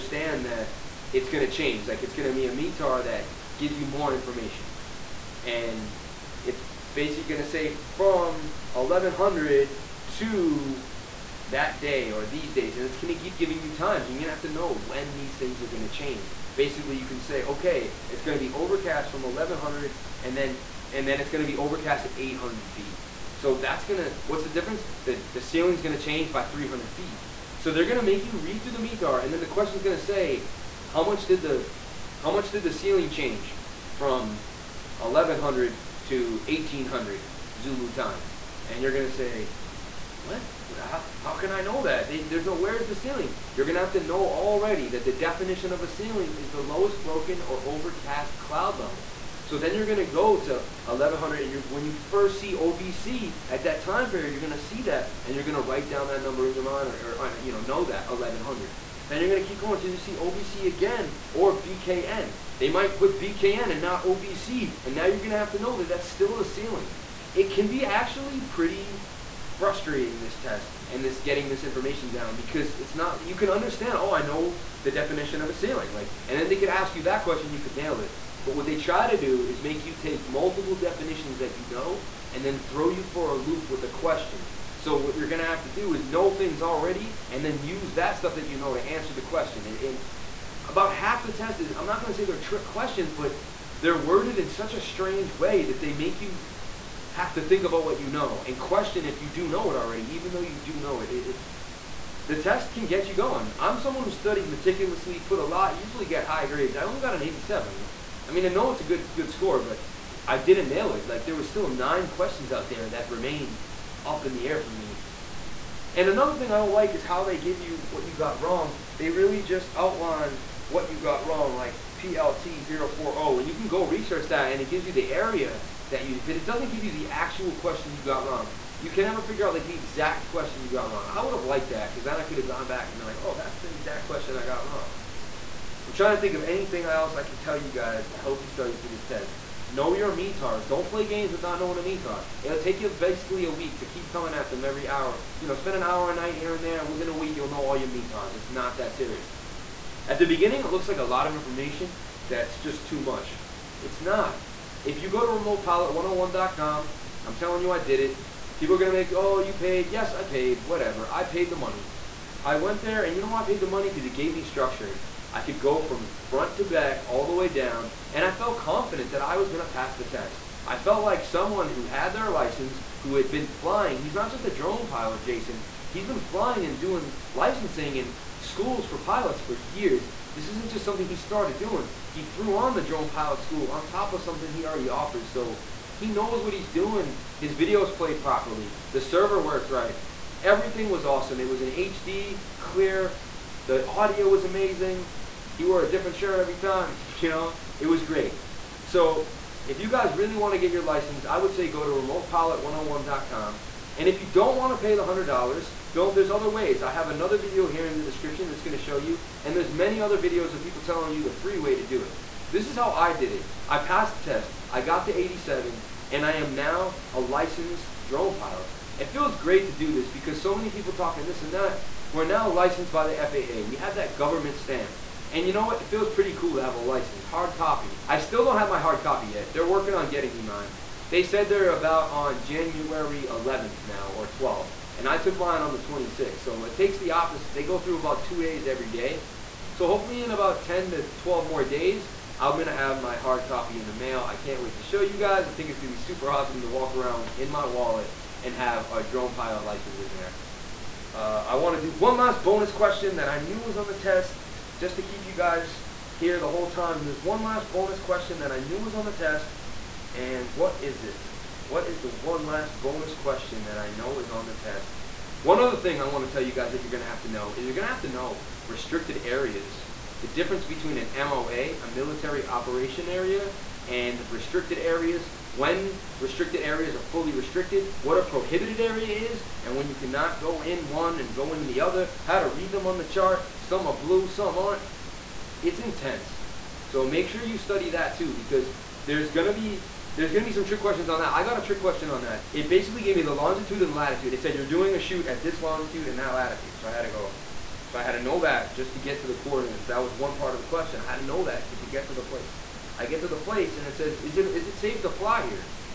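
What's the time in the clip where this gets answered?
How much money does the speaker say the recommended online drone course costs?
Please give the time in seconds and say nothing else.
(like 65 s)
204 s.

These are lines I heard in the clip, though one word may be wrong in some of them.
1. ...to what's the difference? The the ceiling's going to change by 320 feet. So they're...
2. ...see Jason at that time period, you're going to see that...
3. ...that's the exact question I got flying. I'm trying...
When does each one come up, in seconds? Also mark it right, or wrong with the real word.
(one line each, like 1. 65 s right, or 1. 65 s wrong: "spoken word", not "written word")
1. 23 s wrong: "300", not "320"
2. 52 s wrong: "OVC", not "Jason"
3. 133 s wrong: "wrong", not "flying".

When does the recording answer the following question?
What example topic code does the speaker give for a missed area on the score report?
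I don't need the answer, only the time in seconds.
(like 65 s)
121 s.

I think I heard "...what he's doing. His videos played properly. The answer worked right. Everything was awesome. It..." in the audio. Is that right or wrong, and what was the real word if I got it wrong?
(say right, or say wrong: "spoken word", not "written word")
wrong: "server", not "answer".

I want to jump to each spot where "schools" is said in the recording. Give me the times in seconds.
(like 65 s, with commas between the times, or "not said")
178 s, 183 s.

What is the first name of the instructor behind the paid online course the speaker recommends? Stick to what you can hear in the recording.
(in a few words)
Jason.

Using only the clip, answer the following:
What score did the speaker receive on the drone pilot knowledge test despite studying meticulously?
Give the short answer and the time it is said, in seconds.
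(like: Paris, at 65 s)
87, at 106 s.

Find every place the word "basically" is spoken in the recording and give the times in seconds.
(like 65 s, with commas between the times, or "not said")
6 s, 16 s, 142 s, 292 s.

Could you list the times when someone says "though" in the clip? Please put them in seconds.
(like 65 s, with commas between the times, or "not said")
100 s.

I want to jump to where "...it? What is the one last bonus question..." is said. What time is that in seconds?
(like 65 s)
261 s.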